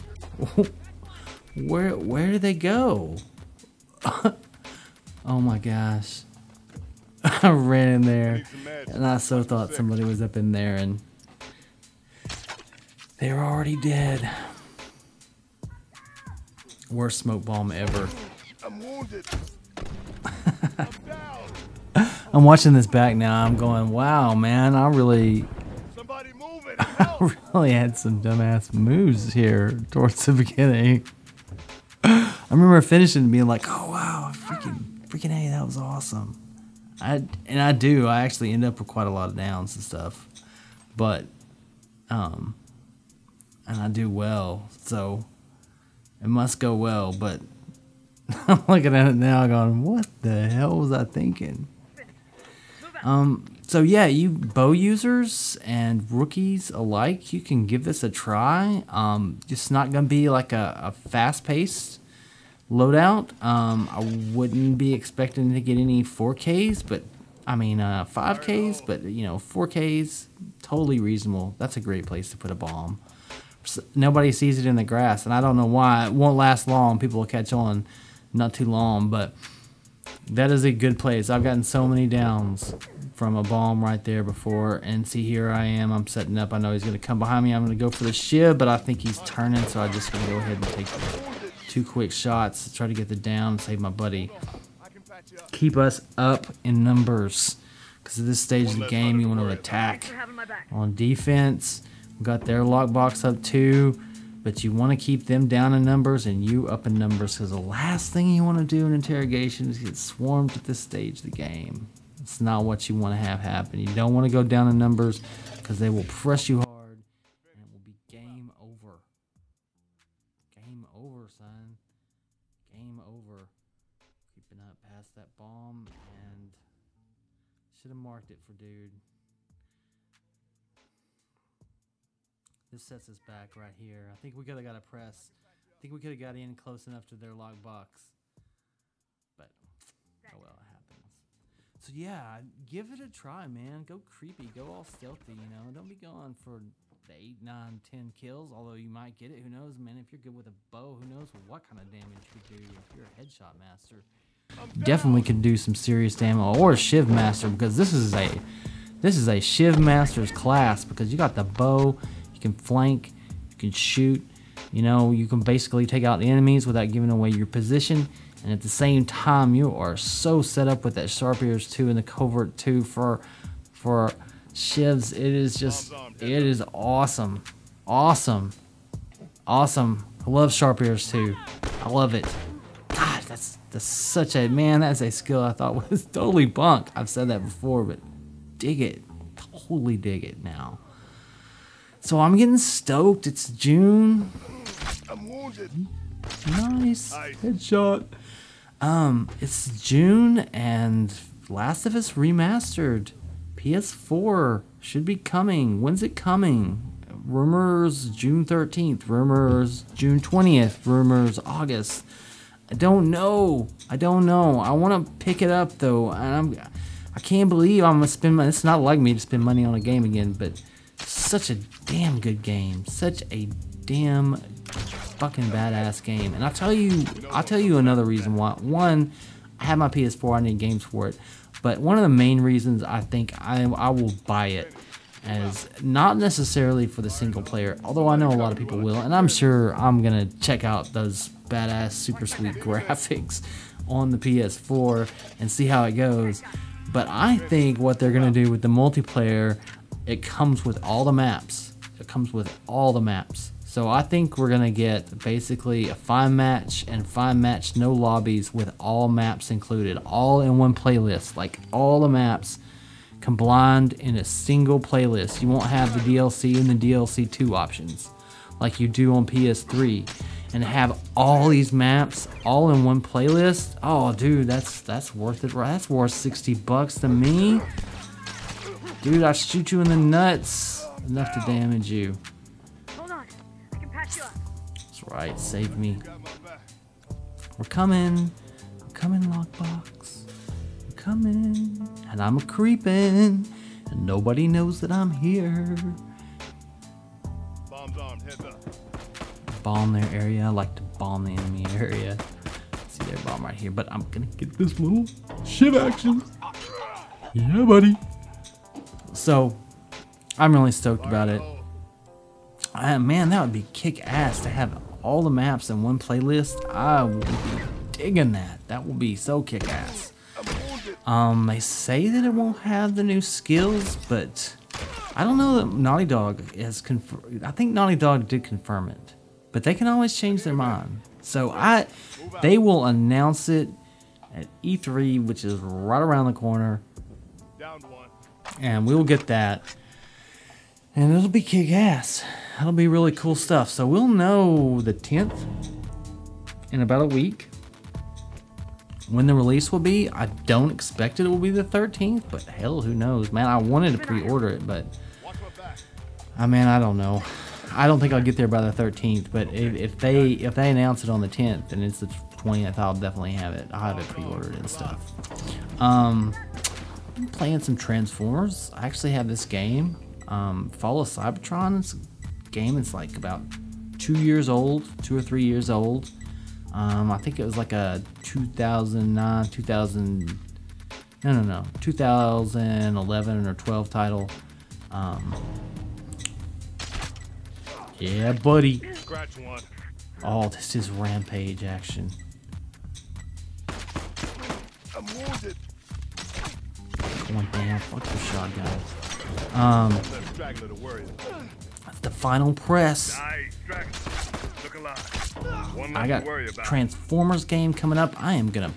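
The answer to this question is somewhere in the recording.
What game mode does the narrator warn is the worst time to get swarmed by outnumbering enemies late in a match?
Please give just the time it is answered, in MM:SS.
01:48.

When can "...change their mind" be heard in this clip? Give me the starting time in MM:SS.
05:30.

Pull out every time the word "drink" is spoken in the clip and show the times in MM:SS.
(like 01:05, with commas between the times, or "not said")
not said.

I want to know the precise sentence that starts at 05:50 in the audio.
I don't expect it will be the 13th, but hell, who knows?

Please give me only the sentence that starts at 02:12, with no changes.
This sets us back right here.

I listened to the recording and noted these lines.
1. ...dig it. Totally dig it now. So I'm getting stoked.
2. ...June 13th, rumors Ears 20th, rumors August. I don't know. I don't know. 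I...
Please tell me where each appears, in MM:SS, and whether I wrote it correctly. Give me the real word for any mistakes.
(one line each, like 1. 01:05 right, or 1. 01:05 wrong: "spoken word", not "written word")
1. 03:08 right
2. 03:28 wrong: "June", not "Ears".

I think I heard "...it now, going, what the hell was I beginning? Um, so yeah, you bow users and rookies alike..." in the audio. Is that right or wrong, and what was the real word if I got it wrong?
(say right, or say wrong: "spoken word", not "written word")
wrong: "thinking", not "beginning".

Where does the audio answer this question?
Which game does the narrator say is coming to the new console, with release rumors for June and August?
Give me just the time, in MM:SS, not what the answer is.
03:21.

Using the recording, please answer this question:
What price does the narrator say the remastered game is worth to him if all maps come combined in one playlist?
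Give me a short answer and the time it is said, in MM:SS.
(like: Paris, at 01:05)
60 bucks, at 04:36.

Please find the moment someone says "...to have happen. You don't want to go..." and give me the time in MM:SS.
01:53.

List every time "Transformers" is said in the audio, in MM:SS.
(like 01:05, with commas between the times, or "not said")
06:07, 06:46.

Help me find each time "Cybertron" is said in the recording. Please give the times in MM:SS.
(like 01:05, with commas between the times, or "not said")
06:11.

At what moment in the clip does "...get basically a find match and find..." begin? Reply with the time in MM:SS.
04:14.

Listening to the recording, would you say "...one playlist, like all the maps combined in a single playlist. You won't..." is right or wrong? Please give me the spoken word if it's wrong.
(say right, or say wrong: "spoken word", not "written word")
right.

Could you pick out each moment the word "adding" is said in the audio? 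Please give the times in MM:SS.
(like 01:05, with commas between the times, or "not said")
not said.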